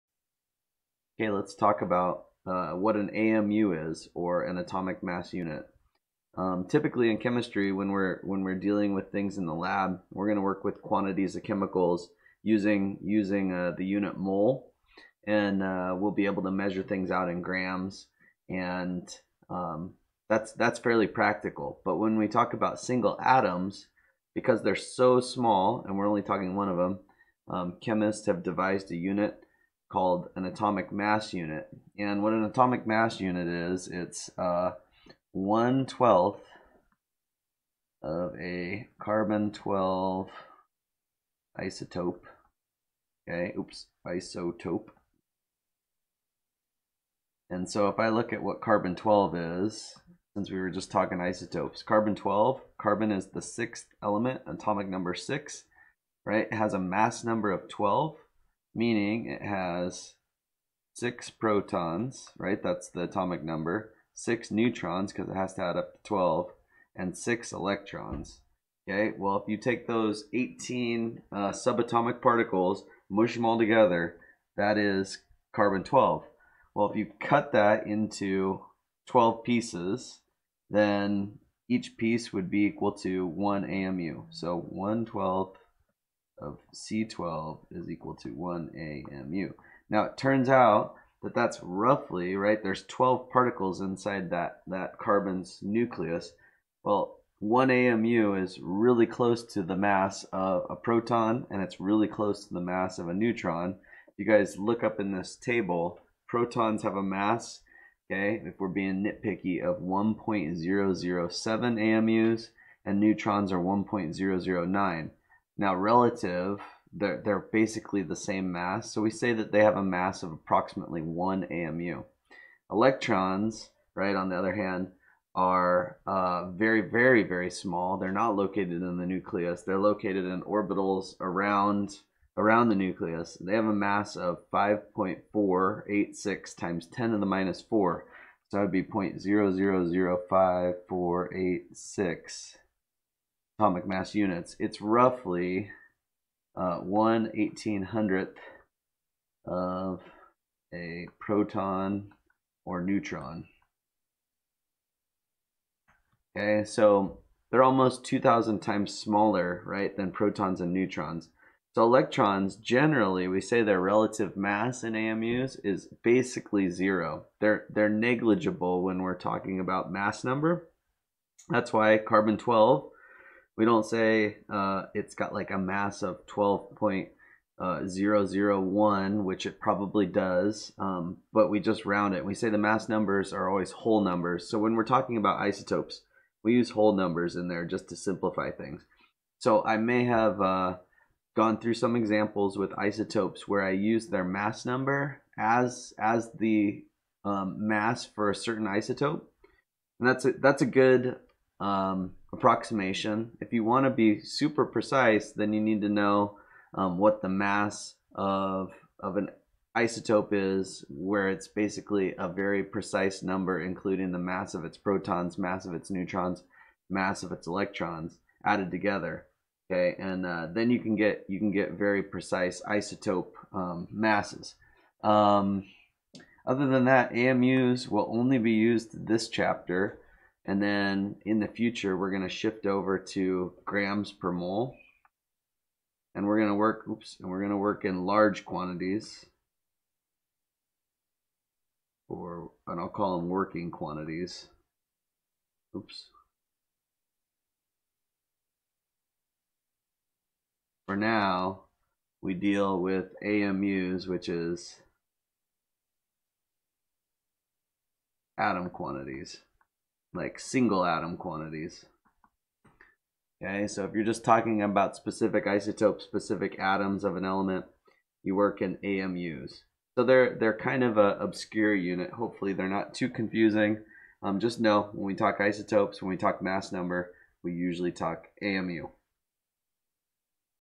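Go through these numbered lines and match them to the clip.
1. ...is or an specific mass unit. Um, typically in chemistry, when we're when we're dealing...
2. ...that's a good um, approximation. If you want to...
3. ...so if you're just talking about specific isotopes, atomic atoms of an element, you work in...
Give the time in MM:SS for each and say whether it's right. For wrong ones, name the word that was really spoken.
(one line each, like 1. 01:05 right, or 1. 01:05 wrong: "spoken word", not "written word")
1. 00:03 wrong: "atomic", not "specific"
2. 03:20 right
3. 04:23 wrong: "specific", not "atomic".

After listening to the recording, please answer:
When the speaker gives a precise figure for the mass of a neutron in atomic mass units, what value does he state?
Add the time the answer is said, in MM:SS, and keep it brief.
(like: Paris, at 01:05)
1.009, at 01:53.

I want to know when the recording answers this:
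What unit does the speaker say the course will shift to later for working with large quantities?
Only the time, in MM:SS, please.
03:53.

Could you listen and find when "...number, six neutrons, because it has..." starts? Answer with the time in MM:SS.
01:03.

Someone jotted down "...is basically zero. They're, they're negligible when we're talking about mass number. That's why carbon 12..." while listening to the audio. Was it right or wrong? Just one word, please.
right.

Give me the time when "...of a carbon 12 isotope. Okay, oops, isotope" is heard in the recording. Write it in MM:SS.
00:38.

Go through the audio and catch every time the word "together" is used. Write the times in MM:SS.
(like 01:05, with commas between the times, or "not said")
01:13, 03:38.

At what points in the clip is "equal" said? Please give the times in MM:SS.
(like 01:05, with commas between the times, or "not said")
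01:22, 01:27.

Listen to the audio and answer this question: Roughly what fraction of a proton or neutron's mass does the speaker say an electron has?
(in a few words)
1/1800.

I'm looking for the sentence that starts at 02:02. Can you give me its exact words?
Electrons, right, on the other hand, are uh, very, very, very small.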